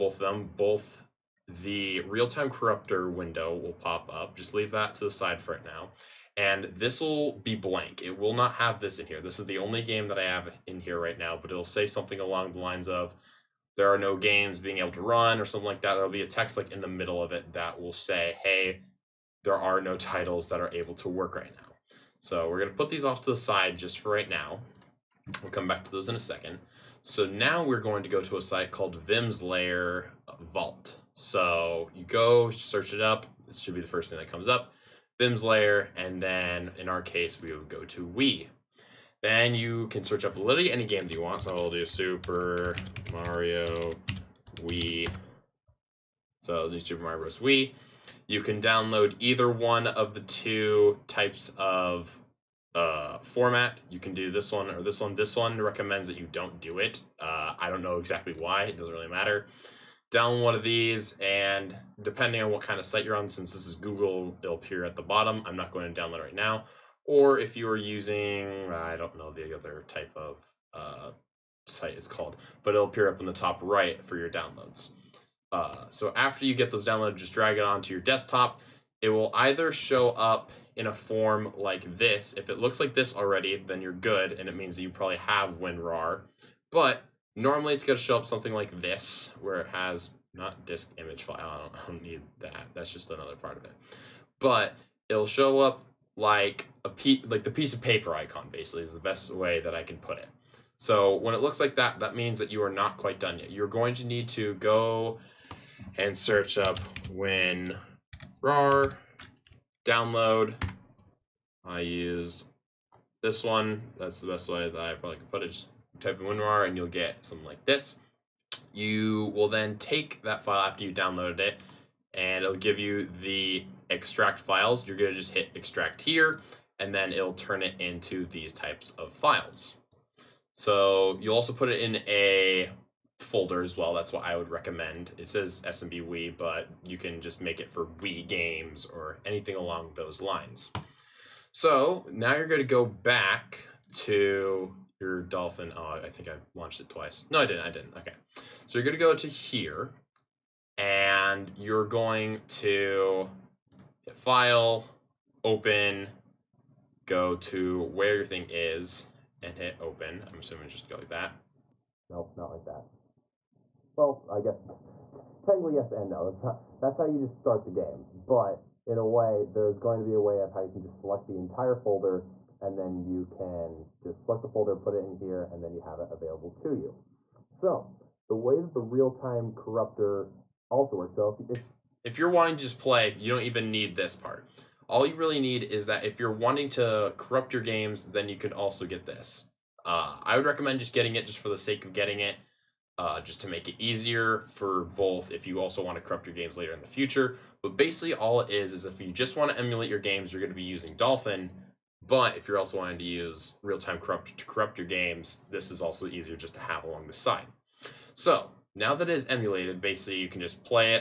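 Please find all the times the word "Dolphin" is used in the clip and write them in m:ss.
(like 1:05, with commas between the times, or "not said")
2:25, 3:20.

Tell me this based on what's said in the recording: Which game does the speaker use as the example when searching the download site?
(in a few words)
Super Mario Bros. Wii.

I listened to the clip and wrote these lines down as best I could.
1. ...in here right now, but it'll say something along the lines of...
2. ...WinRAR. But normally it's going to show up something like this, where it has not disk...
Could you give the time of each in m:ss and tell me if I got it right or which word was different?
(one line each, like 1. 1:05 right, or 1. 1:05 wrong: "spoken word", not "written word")
1. 0:10 right
2. 1:25 right.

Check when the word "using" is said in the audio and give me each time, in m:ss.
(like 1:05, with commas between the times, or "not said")
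1:07, 3:20.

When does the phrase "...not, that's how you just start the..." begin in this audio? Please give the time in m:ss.
2:46.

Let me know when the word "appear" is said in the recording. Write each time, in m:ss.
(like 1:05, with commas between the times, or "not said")
1:04, 1:12.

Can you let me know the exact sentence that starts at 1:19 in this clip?
It will either show up in a form like this.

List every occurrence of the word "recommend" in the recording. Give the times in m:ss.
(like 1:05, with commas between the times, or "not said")
0:55, 2:14, 3:10.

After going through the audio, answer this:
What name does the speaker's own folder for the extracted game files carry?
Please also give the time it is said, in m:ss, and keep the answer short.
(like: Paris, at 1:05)
SMB Wii, at 2:15.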